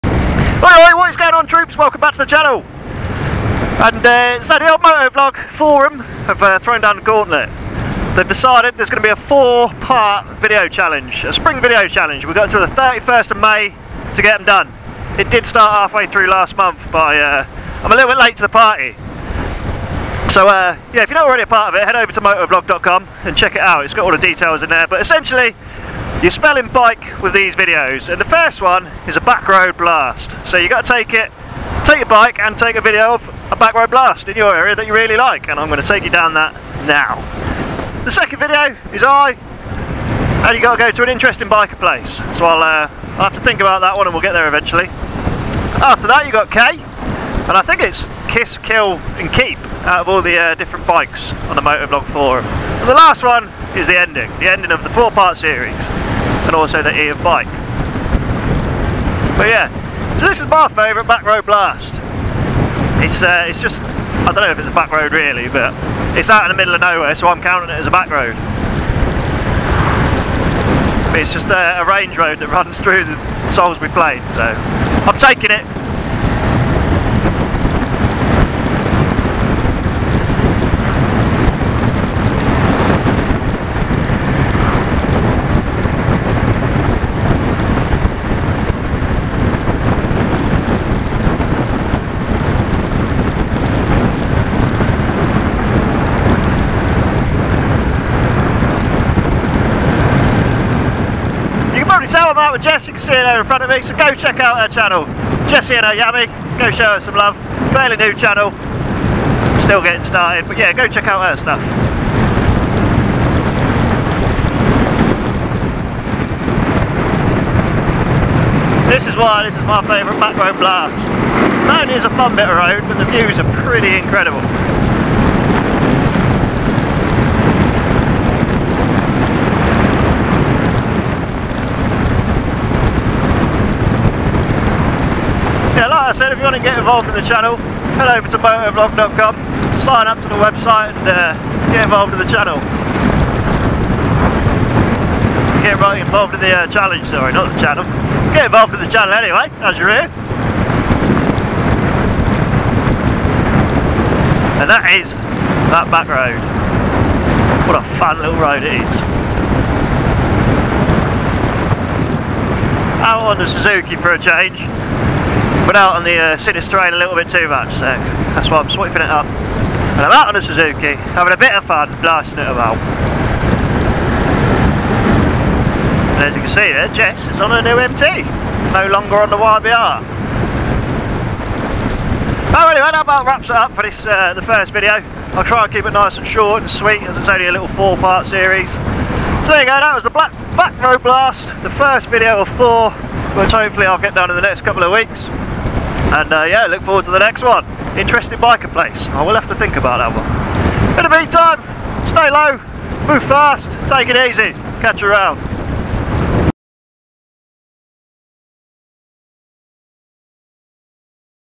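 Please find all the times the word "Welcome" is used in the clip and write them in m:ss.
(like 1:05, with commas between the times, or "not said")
0:01.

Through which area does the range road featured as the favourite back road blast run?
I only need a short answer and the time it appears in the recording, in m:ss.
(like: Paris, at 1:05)
Salisbury Plain, at 1:13.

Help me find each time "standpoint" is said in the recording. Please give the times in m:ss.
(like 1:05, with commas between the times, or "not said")
not said.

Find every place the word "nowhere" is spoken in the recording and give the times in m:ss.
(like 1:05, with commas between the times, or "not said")
1:06.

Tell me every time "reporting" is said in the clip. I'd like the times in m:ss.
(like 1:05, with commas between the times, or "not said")
not said.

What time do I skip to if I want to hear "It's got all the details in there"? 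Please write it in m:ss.
0:23.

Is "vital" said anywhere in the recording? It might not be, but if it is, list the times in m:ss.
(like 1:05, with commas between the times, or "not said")
not said.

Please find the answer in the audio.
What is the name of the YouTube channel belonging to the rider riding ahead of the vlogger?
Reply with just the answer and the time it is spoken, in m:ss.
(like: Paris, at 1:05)
Jessy and her Yammy, at 1:45.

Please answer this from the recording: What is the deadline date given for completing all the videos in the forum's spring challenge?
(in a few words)
31st of May.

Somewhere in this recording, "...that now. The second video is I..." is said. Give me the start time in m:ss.
0:36.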